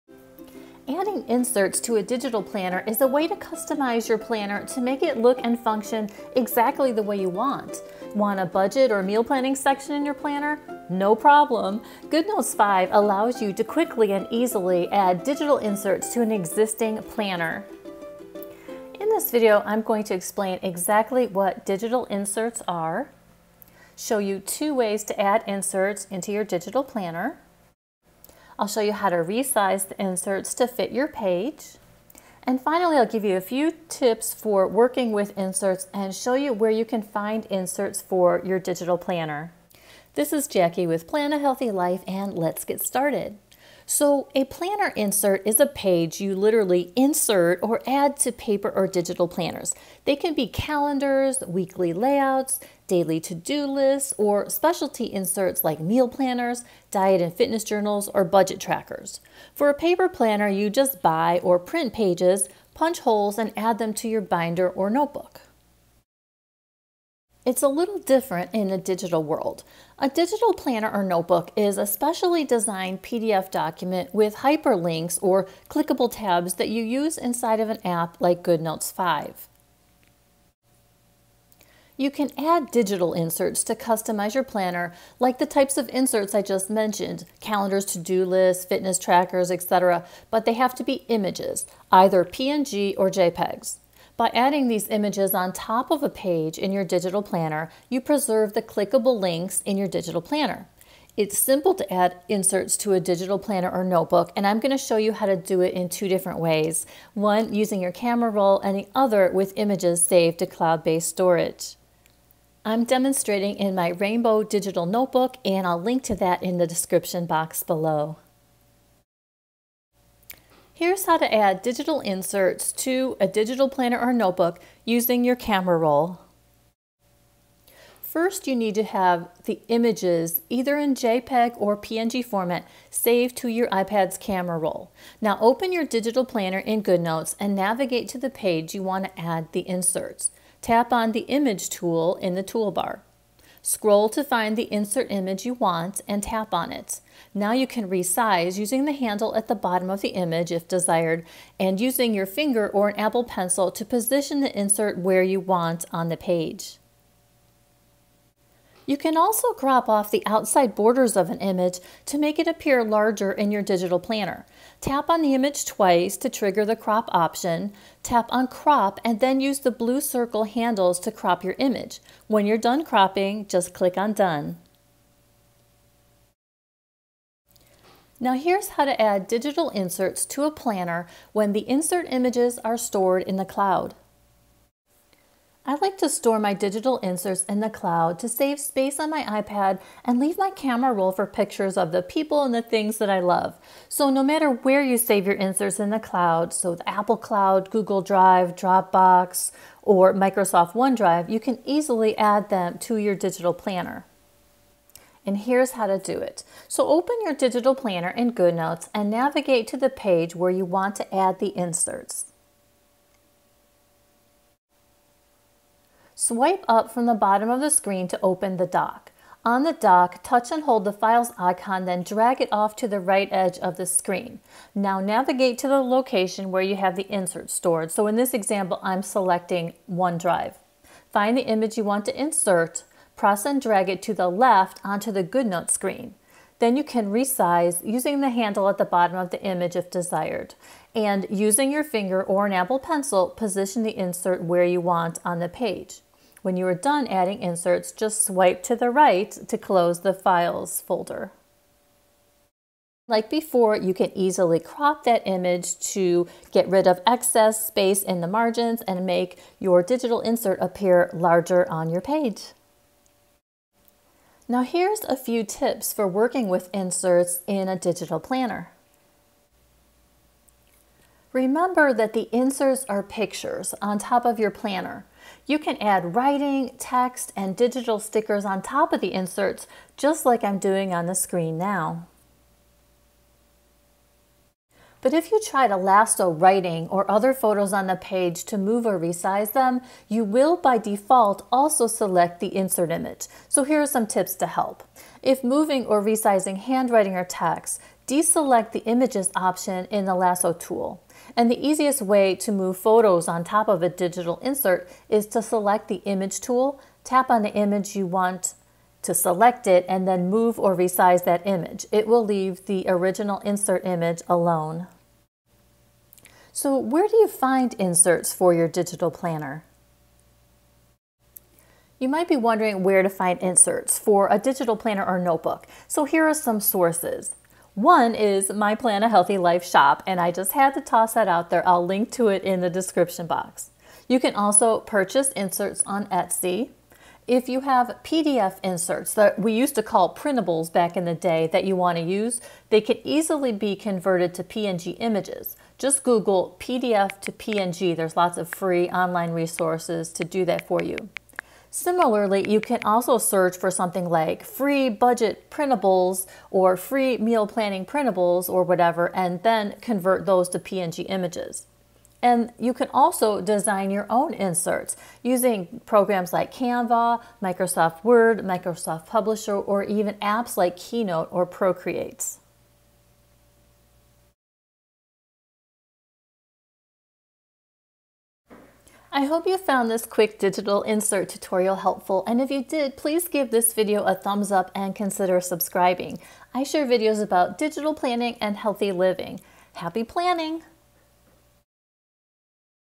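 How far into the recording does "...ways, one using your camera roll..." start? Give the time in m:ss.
1:46.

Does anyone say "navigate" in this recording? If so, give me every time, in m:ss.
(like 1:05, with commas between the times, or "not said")
2:17, 3:29, 3:44.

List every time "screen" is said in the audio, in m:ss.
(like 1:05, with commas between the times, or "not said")
3:37, 3:43, 3:55, 4:41.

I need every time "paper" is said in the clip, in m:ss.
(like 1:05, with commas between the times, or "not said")
0:48, 0:59.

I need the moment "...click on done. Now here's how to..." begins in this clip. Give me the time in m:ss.
2:53.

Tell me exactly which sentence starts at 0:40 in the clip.
This is Jacqui with Plan a Healthy Life and let's get started.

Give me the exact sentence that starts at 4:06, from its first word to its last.
When you are done adding inserts, just swipe to the right to close the Files folder.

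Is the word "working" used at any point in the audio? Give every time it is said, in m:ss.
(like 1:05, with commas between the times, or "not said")
0:34, 4:26.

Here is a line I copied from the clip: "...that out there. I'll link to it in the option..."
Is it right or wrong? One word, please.
wrong.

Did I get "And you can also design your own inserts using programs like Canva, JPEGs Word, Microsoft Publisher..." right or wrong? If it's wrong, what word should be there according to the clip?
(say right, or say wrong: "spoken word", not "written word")
wrong: "Microsoft", not "JPEGs".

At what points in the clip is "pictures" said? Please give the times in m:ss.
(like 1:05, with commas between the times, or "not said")
3:11, 4:33.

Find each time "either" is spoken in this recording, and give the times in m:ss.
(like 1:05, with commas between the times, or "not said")
1:31, 2:10.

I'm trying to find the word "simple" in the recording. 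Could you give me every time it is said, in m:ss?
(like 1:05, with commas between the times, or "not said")
1:41.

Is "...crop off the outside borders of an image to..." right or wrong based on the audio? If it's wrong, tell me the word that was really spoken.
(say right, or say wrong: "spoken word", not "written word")
right.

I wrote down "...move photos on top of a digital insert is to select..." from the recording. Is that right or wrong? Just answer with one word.
right.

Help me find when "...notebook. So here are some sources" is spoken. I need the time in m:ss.
5:25.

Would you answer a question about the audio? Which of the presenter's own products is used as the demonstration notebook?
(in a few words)
Rainbow Digital Notebook.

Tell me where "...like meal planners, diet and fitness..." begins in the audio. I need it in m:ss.
0:55.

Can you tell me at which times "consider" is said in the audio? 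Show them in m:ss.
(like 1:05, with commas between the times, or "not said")
6:24.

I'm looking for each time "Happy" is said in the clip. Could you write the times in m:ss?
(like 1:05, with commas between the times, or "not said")
6:29.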